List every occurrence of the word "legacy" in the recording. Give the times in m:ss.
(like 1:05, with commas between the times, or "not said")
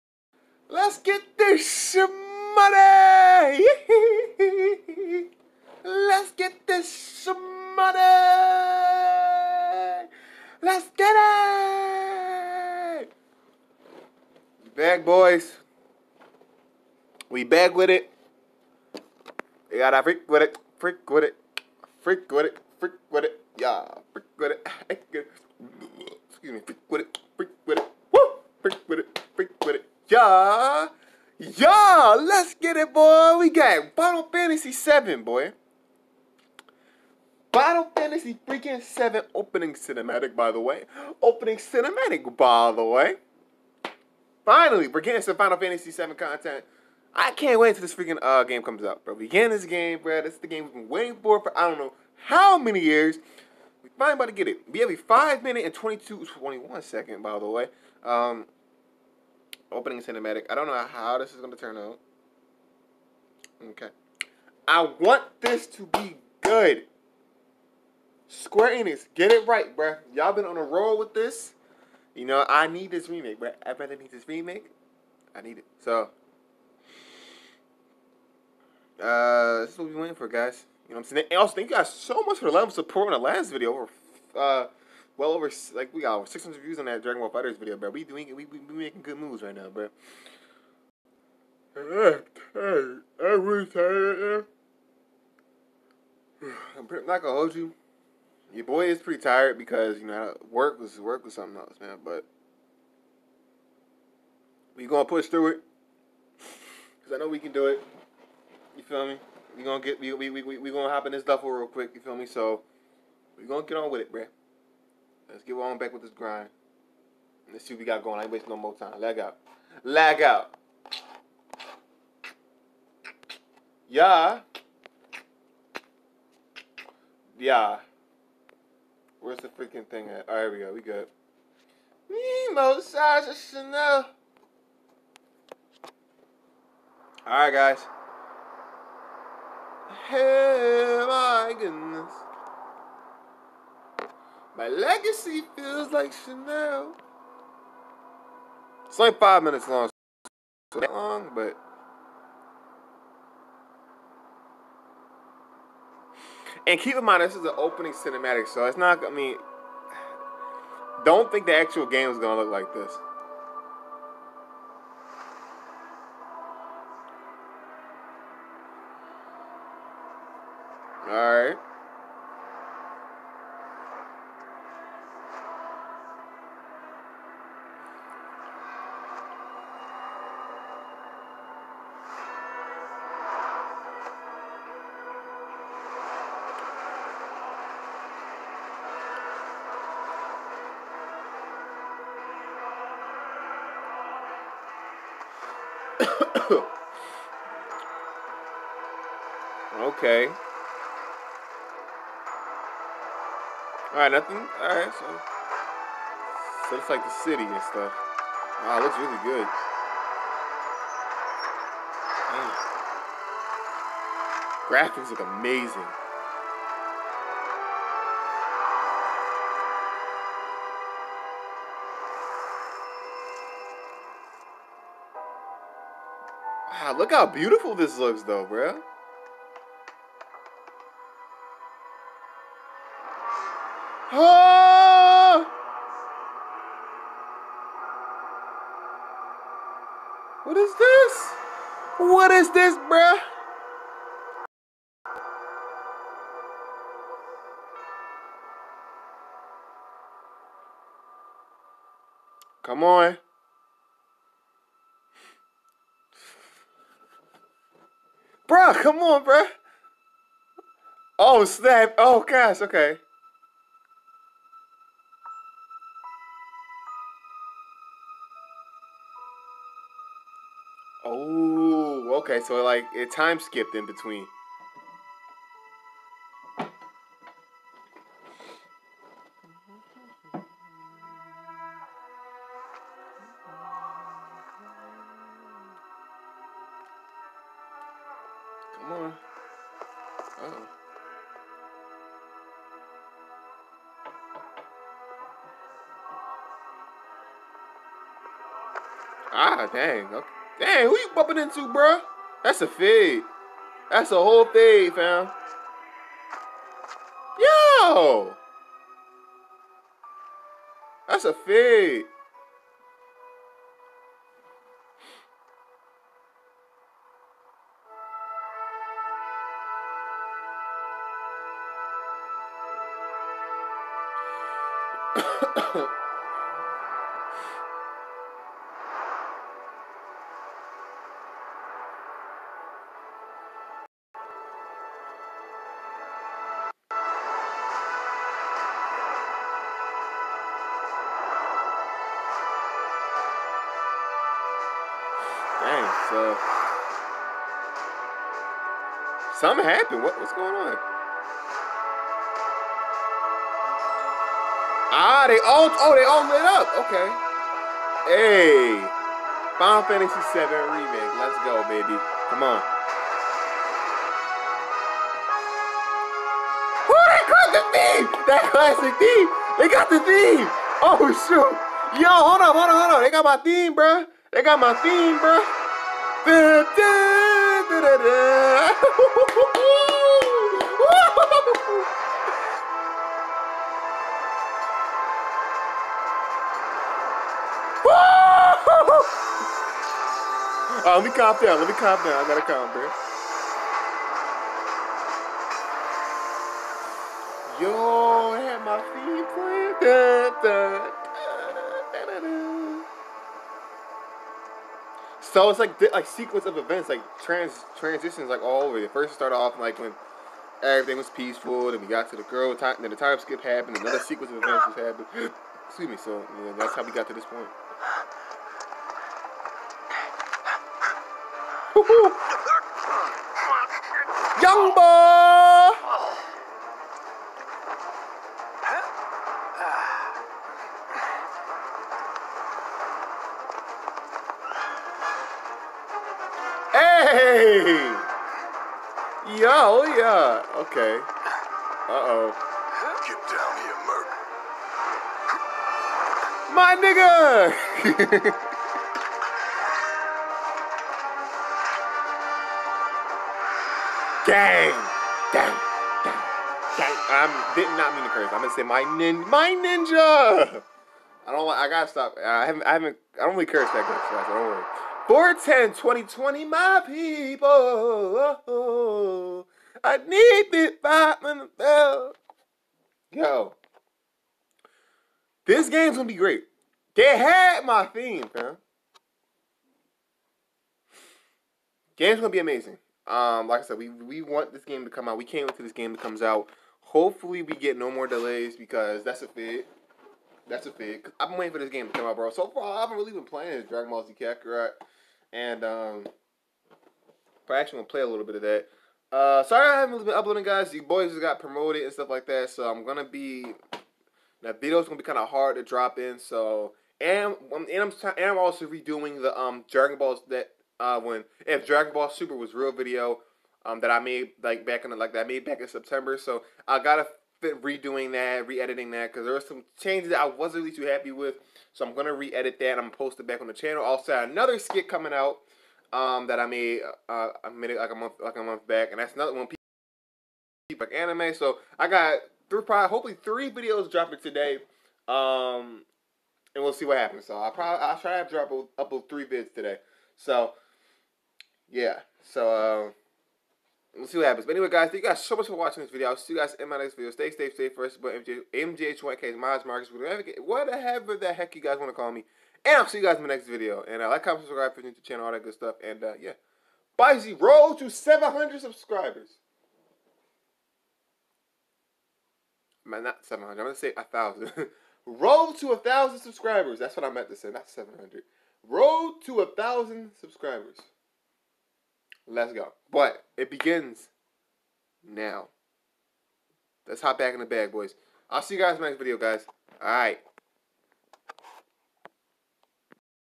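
2:24.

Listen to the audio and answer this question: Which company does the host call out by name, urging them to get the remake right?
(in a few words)
Square Enix.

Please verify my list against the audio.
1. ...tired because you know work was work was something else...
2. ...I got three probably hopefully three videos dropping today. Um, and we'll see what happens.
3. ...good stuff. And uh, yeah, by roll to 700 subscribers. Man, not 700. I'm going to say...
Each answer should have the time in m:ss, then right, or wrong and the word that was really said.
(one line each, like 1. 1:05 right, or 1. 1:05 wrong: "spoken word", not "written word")
1. 1:39 right
2. 8:51 right
3. 9:15 right.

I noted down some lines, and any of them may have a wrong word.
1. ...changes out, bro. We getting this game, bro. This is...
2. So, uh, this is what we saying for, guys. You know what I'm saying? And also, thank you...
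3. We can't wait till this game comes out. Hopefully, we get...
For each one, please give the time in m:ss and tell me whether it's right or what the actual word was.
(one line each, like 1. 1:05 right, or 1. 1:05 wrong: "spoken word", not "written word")
1. 0:48 wrong: "comes", not "changes"
2. 1:15 wrong: "waiting", not "saying"
3. 8:05 right.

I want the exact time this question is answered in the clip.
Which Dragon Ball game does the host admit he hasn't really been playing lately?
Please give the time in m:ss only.
8:13.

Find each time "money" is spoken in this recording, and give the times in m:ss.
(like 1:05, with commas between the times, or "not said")
0:02, 0:07.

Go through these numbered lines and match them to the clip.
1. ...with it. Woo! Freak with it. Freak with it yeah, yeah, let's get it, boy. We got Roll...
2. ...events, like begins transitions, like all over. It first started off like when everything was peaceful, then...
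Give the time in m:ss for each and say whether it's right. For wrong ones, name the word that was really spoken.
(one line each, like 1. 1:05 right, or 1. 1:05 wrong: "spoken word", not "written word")
1. 0:27 wrong: "Final", not "Roll"
2. 6:46 wrong: "trans", not "begins".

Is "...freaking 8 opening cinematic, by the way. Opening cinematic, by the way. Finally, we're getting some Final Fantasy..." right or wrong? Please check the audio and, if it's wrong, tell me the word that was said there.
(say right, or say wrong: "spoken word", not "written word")
wrong: "7", not "8".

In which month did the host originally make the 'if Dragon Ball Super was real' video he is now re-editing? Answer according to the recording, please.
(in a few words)
September.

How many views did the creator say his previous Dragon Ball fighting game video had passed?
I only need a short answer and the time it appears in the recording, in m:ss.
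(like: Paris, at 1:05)
600, at 1:26.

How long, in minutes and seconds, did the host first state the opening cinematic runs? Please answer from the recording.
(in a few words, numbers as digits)
5 minutes 22 seconds.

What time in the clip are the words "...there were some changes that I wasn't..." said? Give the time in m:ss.
8:39.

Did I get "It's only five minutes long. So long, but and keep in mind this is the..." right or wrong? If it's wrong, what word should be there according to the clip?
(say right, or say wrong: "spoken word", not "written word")
right.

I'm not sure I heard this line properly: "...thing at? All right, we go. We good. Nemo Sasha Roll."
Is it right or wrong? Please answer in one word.
wrong.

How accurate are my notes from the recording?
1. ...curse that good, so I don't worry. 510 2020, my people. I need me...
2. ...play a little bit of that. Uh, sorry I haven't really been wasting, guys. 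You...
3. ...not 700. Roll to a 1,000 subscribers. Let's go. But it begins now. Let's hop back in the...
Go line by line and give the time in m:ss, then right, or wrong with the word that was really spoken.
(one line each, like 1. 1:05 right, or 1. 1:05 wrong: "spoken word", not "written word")
1. 7:43 wrong: "410", not "510"
2. 8:17 wrong: "uploading", not "wasting"
3. 9:27 right.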